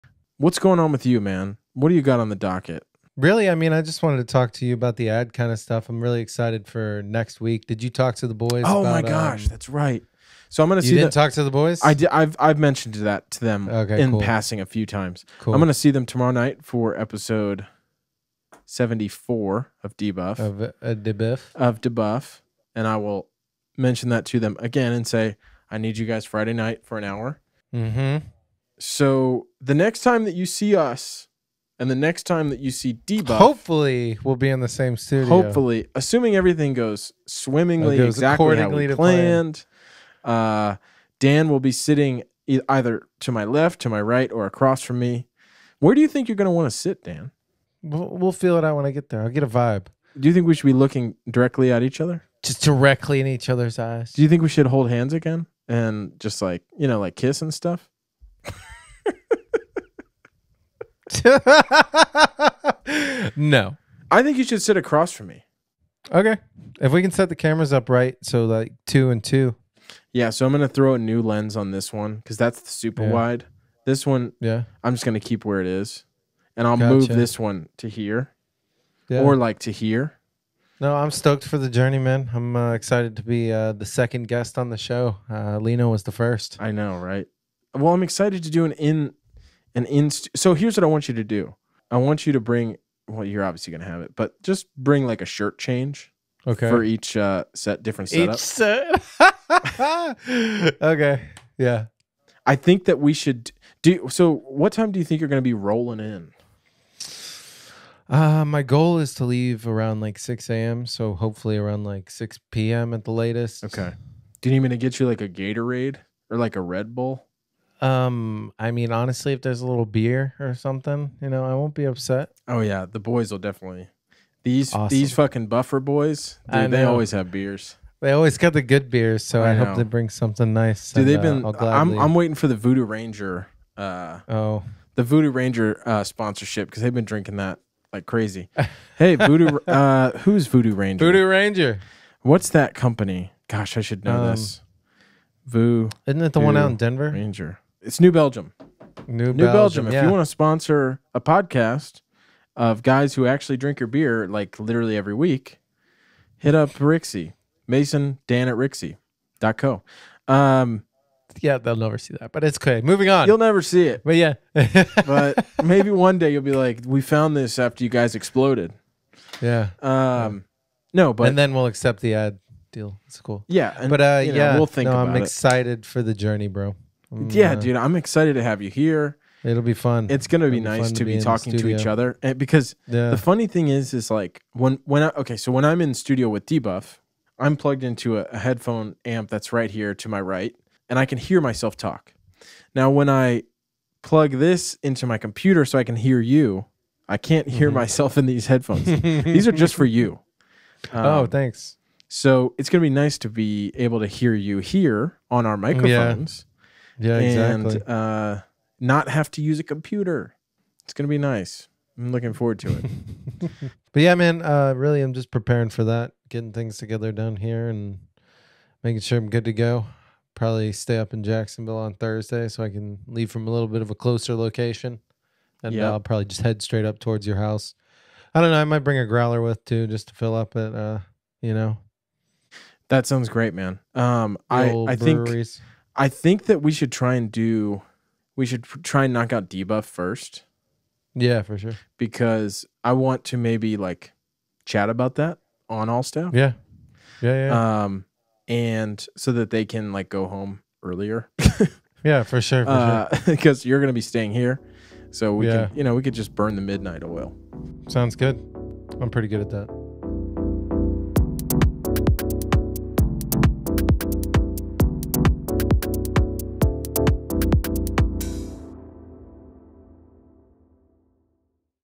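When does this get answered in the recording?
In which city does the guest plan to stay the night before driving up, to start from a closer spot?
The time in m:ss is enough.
3:41.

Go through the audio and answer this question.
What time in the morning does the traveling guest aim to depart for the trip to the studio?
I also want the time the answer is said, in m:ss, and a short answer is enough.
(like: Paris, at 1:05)
6 a.m., at 1:50.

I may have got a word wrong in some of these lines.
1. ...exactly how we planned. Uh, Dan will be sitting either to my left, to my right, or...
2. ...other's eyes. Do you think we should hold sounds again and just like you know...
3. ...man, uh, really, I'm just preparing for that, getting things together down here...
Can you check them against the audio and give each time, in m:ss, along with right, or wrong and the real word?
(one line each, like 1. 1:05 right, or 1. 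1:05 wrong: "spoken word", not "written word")
1. 0:38 right
2. 0:53 wrong: "hands", not "sounds"
3. 3:34 right.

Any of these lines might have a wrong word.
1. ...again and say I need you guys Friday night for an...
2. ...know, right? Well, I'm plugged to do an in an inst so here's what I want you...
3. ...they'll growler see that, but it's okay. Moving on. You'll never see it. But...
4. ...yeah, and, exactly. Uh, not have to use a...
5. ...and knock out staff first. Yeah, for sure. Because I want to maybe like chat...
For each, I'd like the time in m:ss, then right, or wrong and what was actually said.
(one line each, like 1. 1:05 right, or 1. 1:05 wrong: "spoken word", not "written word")
1. 0:24 right
2. 1:26 wrong: "excited", not "plugged"
3. 2:41 wrong: "never", not "growler"
4. 3:26 right
5. 3:59 wrong: "debuff", not "staff".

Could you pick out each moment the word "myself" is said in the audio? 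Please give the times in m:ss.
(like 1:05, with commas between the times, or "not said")
3:11, 3:17.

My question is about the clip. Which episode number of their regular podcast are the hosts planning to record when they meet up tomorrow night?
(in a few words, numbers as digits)
74.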